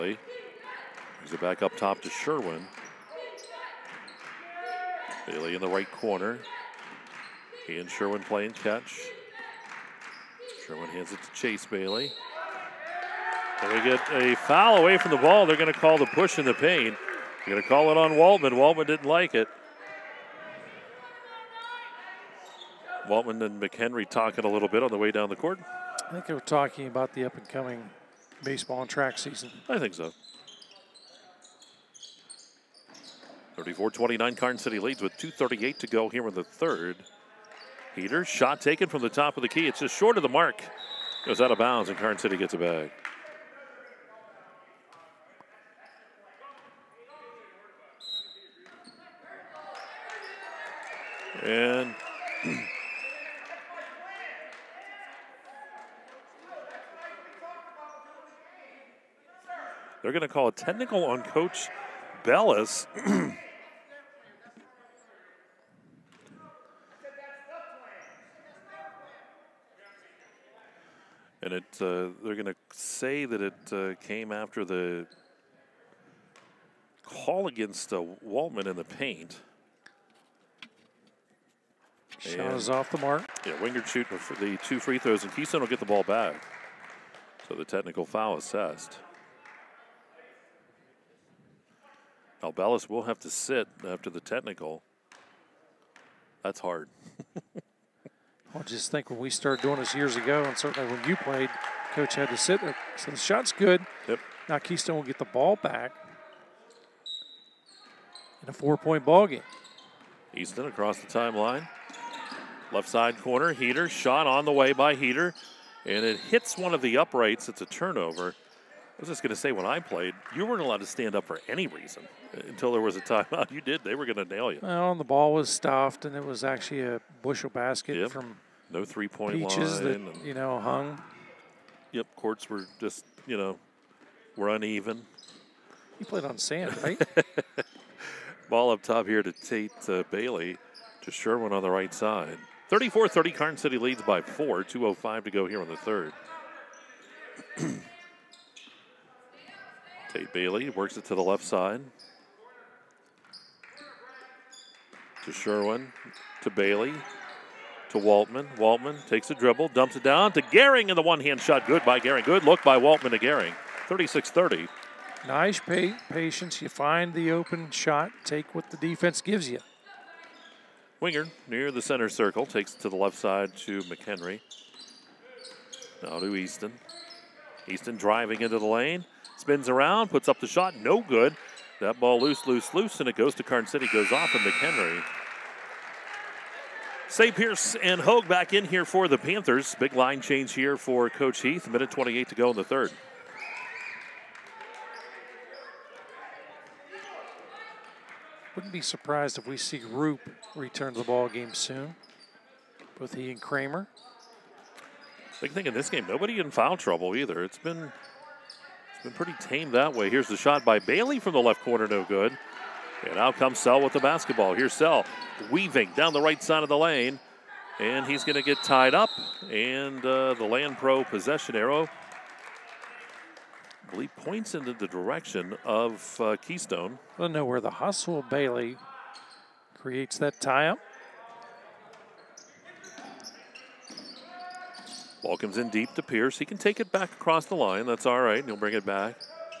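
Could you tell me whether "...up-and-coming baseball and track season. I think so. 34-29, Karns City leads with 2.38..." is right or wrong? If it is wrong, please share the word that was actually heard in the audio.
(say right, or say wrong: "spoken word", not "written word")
right.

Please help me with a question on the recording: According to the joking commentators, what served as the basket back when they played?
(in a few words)
A bushel basket.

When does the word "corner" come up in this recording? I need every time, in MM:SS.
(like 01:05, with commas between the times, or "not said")
00:05, 01:53, 03:31.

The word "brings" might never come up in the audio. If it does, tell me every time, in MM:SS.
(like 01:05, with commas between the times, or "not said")
00:01, 03:58.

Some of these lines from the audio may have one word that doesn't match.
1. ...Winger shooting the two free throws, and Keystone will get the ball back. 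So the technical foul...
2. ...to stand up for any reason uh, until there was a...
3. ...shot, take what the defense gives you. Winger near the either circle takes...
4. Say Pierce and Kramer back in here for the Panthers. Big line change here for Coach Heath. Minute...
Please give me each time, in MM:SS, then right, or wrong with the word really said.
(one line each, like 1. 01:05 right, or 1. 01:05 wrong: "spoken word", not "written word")
1. 01:23 right
2. 02:00 right
3. 02:47 wrong: "center", not "either"
4. 03:07 wrong: "Hogue", not "Kramer".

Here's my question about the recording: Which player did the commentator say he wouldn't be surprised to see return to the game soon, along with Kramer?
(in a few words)
Roop.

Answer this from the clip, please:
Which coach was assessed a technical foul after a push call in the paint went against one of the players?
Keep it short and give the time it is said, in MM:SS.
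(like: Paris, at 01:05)
Coach Bellis, at 01:01.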